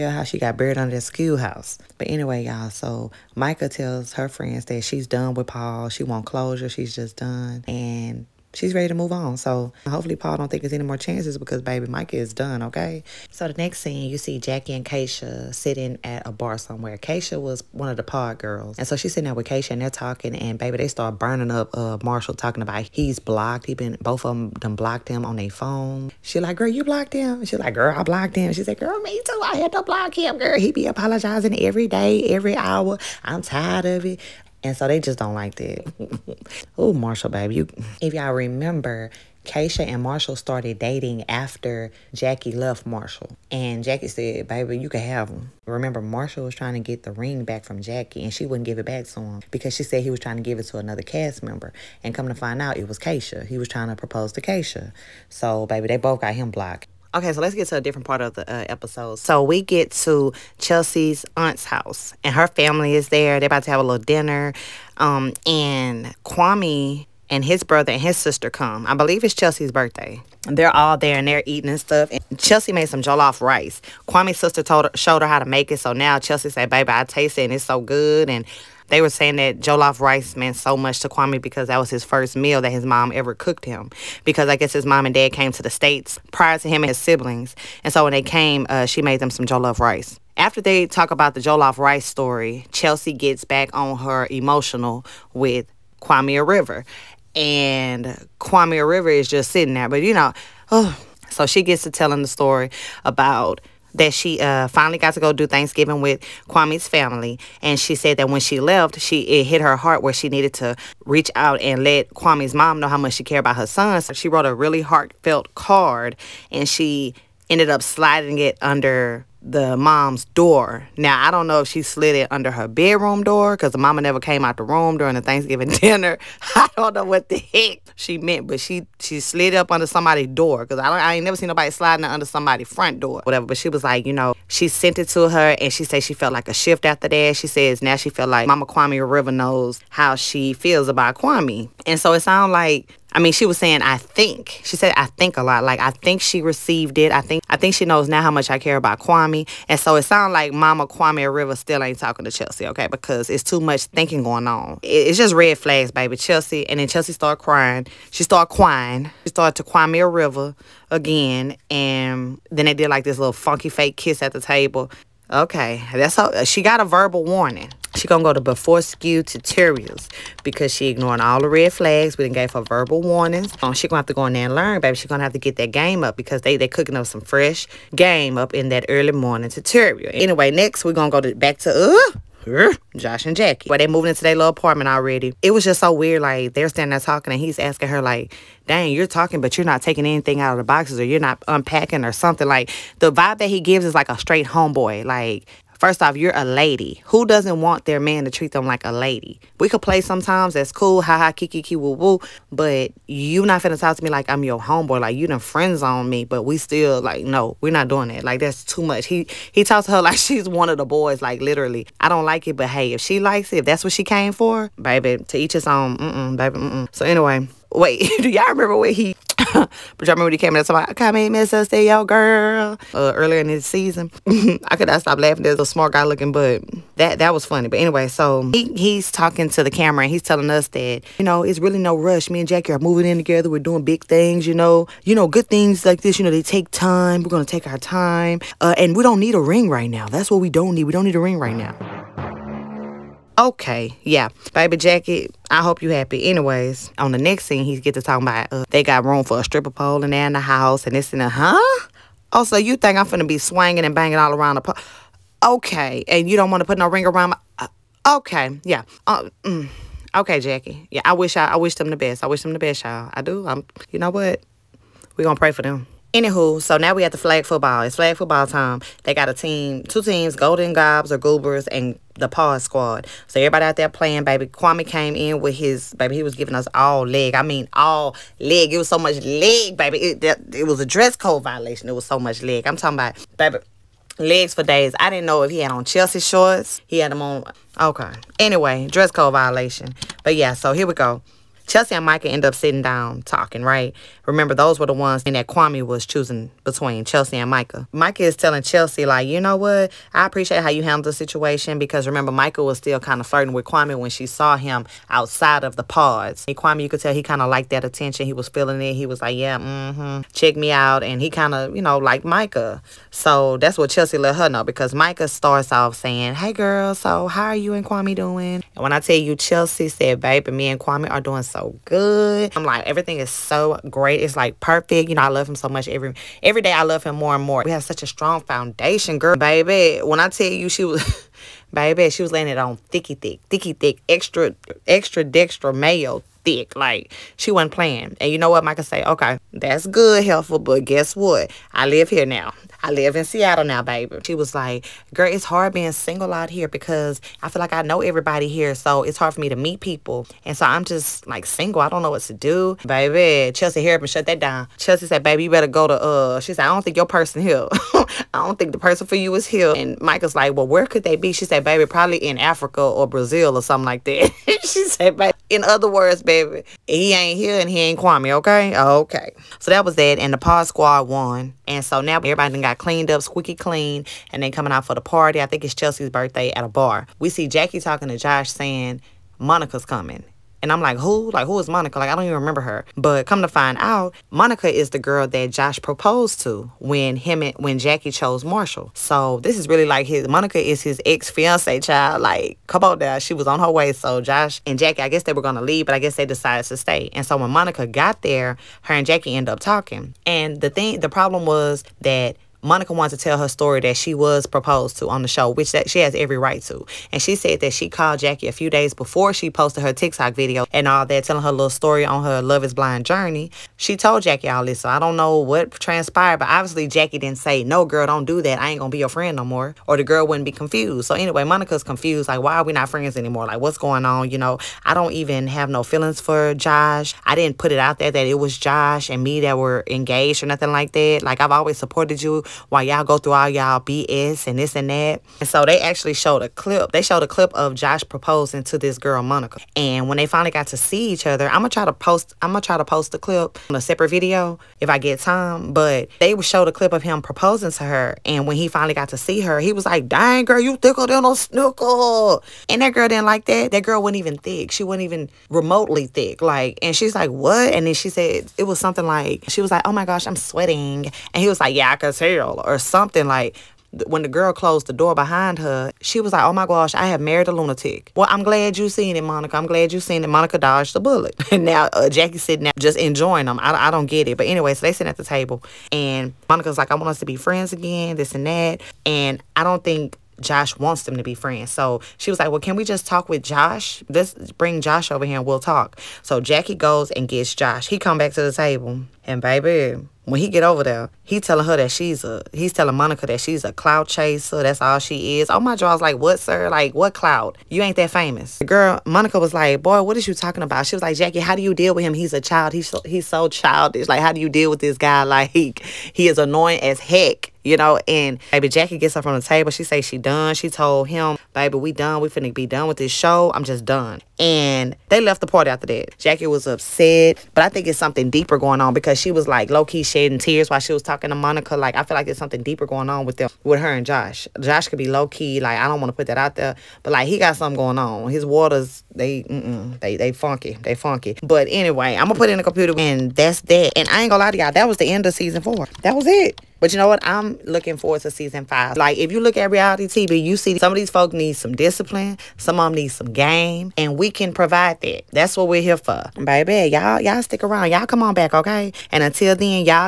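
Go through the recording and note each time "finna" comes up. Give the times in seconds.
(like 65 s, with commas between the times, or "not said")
203 s, 253 s, 512 s.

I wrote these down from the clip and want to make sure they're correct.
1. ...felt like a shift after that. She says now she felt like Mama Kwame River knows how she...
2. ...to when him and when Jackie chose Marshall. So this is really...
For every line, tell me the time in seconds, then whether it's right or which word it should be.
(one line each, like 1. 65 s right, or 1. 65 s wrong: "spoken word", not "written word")
1. 136 s right
2. 386 s right.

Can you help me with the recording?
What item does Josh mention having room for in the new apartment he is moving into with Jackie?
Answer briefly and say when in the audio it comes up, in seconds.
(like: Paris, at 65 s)
stripper pole, at 249 s.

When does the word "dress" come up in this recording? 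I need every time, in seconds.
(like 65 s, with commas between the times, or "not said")
280 s, 288 s.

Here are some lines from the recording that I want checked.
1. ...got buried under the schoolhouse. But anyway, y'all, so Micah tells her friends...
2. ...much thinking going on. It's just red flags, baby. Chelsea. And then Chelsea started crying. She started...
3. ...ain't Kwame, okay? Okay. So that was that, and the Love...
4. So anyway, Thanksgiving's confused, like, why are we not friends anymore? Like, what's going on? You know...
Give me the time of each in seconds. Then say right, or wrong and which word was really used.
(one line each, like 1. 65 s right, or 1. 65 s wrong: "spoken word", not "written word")
1. 0 s right
2. 153 s right
3. 367 s wrong: "Pod", not "Love"
4. 421 s wrong: "Monica", not "Thanksgiving".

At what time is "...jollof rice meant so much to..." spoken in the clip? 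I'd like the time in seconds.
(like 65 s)
79 s.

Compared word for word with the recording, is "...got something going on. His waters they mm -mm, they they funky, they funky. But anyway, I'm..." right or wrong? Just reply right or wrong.
right.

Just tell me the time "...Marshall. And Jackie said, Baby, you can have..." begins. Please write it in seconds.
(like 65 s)
42 s.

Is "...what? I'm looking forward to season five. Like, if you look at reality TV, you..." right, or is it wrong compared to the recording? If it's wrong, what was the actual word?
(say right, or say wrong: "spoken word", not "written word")
right.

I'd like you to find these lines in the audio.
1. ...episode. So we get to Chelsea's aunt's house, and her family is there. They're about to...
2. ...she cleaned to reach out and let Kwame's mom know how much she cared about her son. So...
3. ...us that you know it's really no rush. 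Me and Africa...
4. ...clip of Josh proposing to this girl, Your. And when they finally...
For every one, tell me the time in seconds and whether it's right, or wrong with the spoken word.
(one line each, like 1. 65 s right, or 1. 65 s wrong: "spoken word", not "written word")
1. 58 s right
2. 110 s wrong: "needed", not "cleaned"
3. 230 s wrong: "Jackie", not "Africa"
4. 437 s wrong: "Monica", not "Your".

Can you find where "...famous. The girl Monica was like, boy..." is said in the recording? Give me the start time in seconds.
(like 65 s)
498 s.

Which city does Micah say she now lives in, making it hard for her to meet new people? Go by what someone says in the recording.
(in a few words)
Seattle.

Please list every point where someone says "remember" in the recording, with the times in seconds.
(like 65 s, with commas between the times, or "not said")
38 s, 45 s, 218 s, 294 s, 302 s, 382 s.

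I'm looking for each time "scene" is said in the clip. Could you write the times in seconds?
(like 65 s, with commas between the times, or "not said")
13 s, 247 s.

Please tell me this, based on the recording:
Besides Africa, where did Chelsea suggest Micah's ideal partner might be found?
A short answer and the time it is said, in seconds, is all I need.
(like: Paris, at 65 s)
Brazil, at 363 s.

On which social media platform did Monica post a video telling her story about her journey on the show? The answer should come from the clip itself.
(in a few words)
TikTok.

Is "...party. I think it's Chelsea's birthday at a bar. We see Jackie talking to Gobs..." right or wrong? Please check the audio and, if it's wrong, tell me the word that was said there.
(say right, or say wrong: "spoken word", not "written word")
wrong: "Josh", not "Gobs".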